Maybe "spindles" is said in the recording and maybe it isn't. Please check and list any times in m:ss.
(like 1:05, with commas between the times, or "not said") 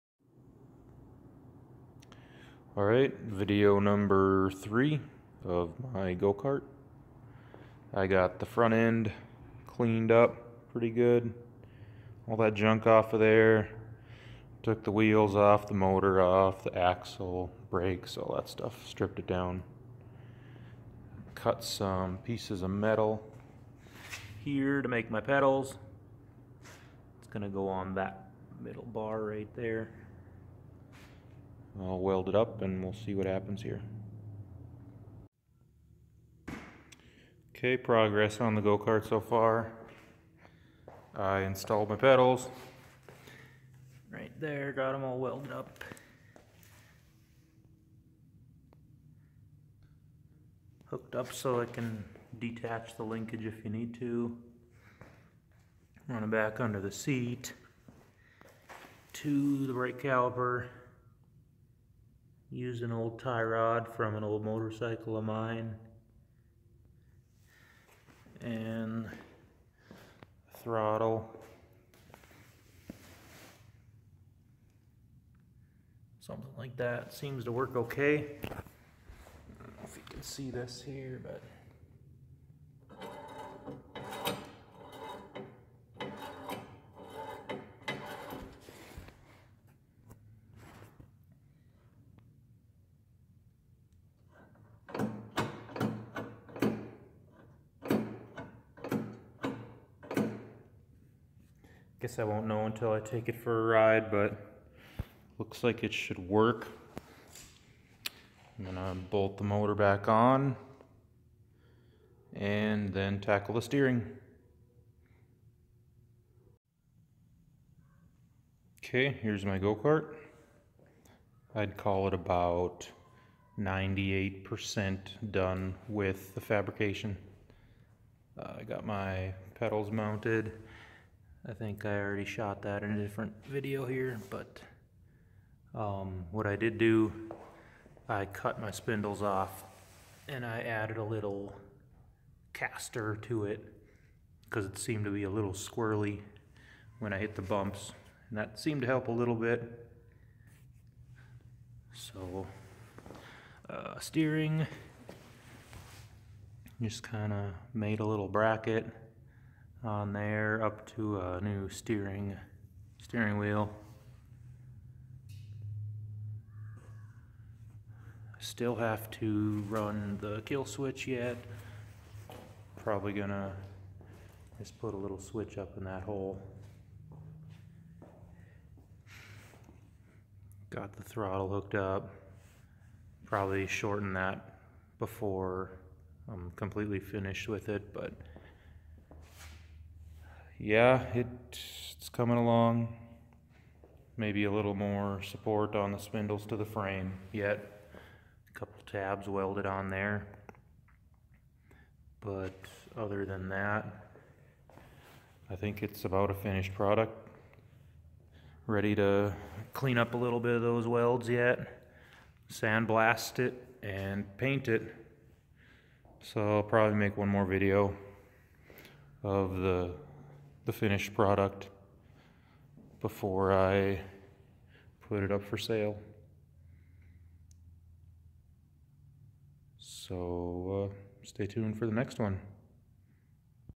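2:18, 3:15.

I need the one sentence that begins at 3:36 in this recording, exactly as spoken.
So I'll probably make one more video of the the finished product before I put it up for sale.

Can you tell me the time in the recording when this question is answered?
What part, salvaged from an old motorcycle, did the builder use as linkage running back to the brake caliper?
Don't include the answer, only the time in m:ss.
1:03.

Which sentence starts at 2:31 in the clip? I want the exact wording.
So uh, steering, just kind of made a little bracket on there up to a new steering steering wheel.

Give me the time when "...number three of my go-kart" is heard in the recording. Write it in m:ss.
0:03.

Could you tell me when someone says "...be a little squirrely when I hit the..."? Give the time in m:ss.
2:25.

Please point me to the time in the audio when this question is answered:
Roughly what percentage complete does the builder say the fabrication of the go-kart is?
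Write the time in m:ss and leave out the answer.
2:03.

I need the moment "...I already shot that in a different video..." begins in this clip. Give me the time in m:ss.
2:11.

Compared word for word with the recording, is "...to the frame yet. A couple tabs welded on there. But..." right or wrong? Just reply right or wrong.
right.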